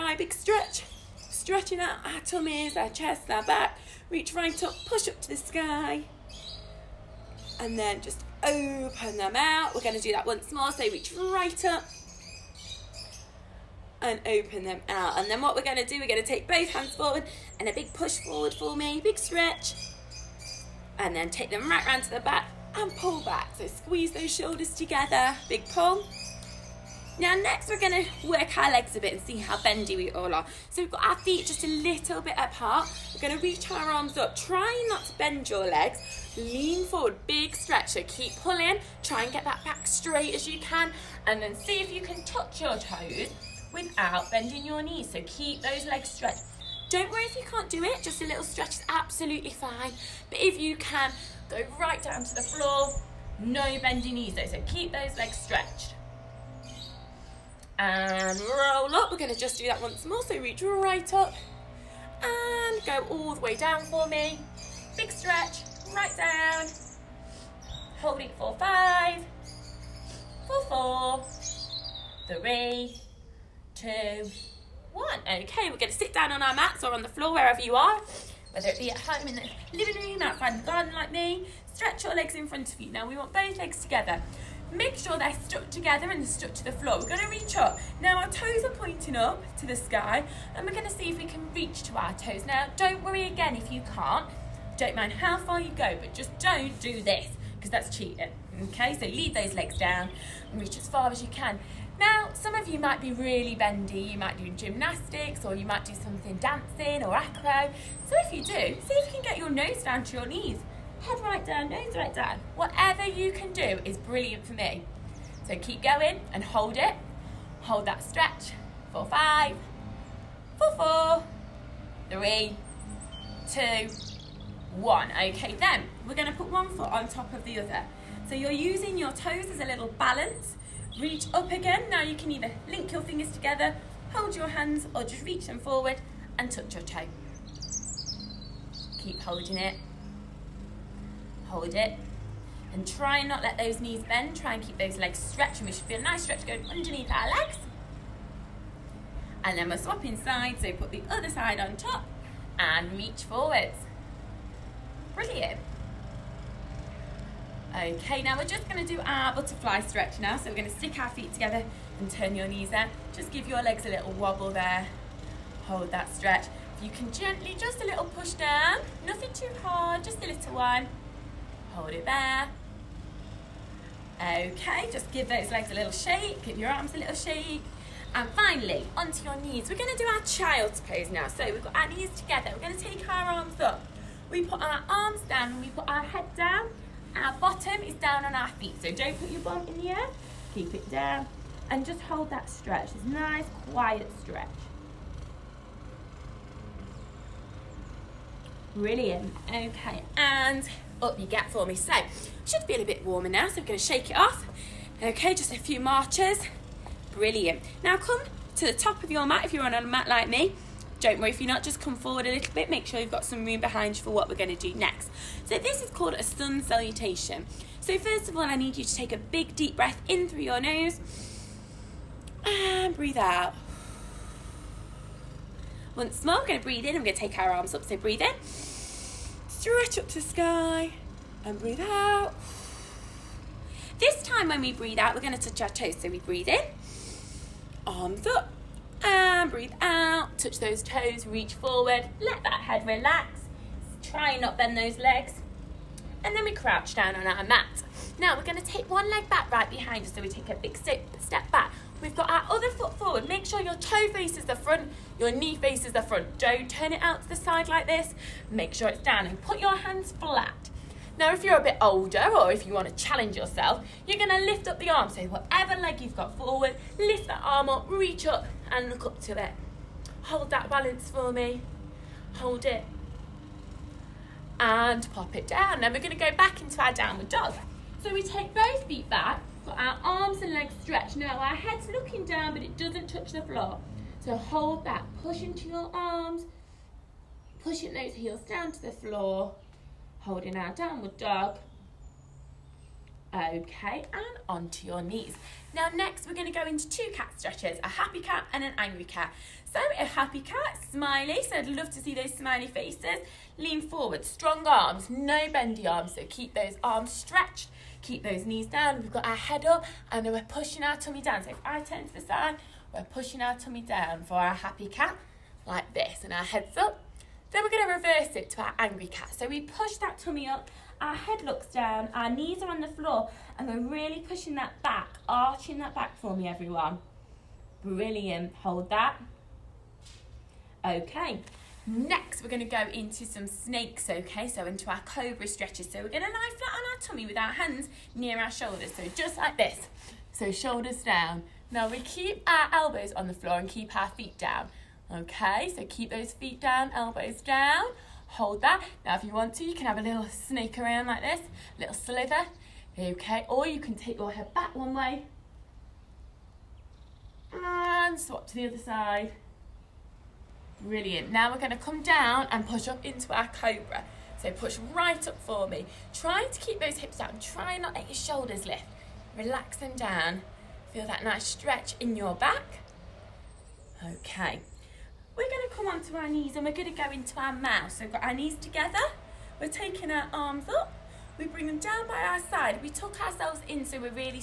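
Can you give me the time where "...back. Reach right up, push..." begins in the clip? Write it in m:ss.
0:03.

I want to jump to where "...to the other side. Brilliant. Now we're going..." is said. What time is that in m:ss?
5:58.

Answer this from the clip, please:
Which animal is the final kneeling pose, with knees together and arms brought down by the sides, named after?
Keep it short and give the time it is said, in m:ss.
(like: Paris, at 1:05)
Mouse, at 6:17.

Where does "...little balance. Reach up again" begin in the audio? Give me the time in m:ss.
2:09.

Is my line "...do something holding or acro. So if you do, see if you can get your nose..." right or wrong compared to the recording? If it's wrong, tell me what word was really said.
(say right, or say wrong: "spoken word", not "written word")
wrong: "dancing", not "holding".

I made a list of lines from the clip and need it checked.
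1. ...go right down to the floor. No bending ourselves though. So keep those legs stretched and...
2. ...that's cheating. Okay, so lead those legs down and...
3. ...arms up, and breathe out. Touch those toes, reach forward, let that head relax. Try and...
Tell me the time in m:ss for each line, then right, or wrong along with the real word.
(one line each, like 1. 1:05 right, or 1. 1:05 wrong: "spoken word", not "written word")
1. 0:51 wrong: "knees", not "ourselves"
2. 1:37 right
3. 3:57 right.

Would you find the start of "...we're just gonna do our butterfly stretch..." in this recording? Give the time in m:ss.
2:38.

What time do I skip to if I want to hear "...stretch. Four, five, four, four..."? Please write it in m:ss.
1:58.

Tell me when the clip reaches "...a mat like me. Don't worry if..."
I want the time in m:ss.
3:29.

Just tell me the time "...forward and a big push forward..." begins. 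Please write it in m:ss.
0:16.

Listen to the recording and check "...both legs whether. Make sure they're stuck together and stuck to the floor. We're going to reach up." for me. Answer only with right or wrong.
wrong.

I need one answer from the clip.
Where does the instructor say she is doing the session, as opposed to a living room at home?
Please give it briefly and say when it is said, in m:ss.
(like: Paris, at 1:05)
Outside in the garden, at 1:20.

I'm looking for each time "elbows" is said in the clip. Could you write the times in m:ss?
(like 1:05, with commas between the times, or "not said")
5:42, 5:46.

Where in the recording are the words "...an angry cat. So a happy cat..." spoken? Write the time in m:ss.
4:58.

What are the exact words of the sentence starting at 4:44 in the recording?
So hold that, push into your arms, pushing those heels down to the floor, holding our downward dog.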